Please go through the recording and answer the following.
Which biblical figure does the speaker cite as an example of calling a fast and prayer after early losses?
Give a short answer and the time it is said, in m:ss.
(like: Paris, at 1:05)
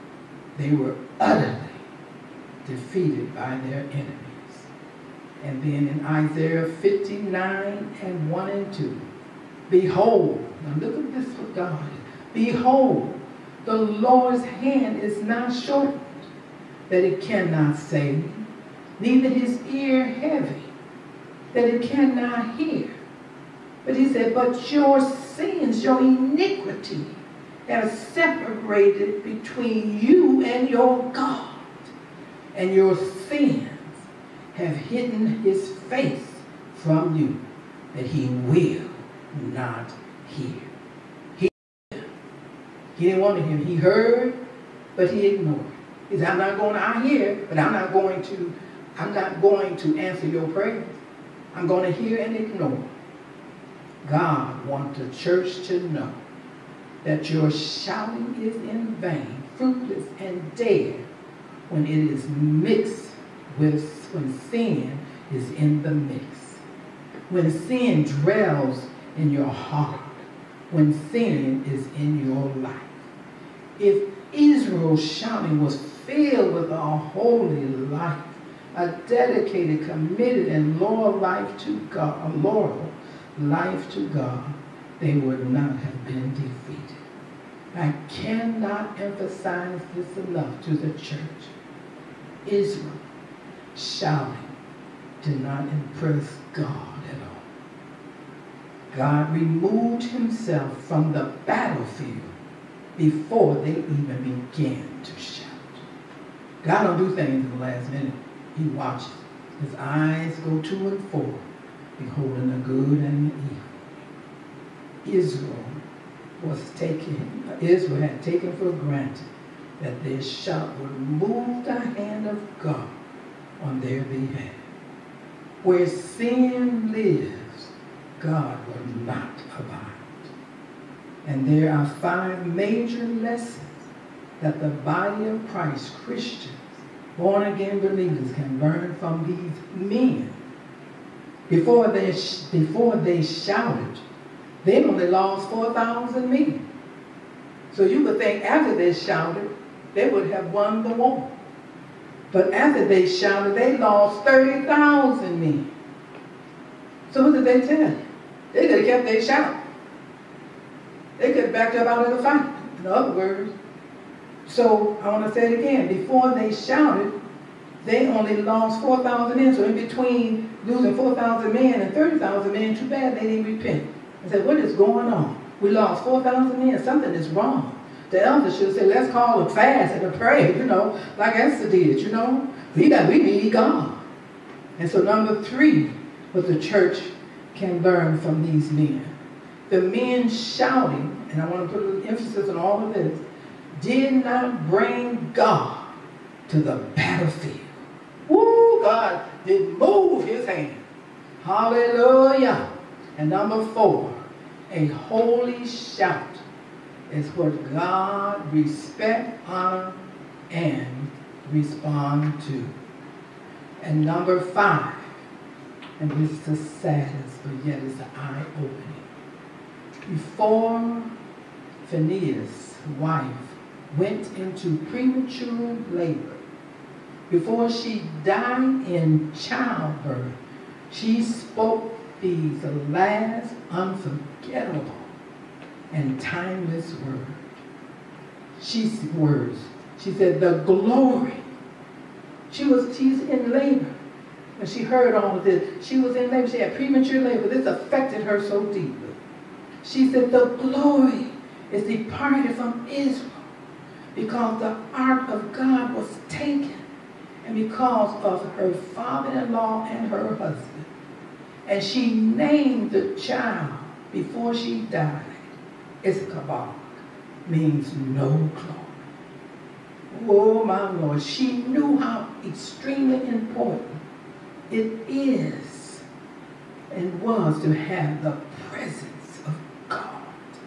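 Esther, at 3:01.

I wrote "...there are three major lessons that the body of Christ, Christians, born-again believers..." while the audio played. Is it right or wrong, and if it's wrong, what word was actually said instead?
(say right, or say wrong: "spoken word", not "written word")
wrong: "five", not "three".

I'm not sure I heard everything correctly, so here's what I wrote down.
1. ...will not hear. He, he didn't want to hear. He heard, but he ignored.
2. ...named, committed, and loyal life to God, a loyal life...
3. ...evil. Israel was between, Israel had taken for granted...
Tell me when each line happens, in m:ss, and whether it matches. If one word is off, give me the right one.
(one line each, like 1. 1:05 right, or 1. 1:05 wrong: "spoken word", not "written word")
1. 0:38 right
2. 1:19 wrong: "dedicated", not "named"
3. 1:55 wrong: "taken", not "between".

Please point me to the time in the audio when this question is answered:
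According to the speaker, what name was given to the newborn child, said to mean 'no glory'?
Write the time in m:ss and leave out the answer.
4:26.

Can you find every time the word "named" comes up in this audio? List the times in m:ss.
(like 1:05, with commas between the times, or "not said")
4:22.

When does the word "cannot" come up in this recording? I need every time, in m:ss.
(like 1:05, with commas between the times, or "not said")
0:17, 0:21, 1:28.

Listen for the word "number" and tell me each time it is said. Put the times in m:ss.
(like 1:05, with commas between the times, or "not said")
3:05, 3:23, 3:34.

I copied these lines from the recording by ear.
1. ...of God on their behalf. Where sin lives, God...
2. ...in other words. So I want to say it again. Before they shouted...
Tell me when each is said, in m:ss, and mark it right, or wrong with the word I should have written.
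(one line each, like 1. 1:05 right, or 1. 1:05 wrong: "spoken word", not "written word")
1. 2:02 right
2. 2:42 right.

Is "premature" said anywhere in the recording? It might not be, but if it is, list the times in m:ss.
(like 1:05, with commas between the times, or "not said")
3:44, 4:06.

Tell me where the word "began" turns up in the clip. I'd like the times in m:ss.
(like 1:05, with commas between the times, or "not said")
1:44.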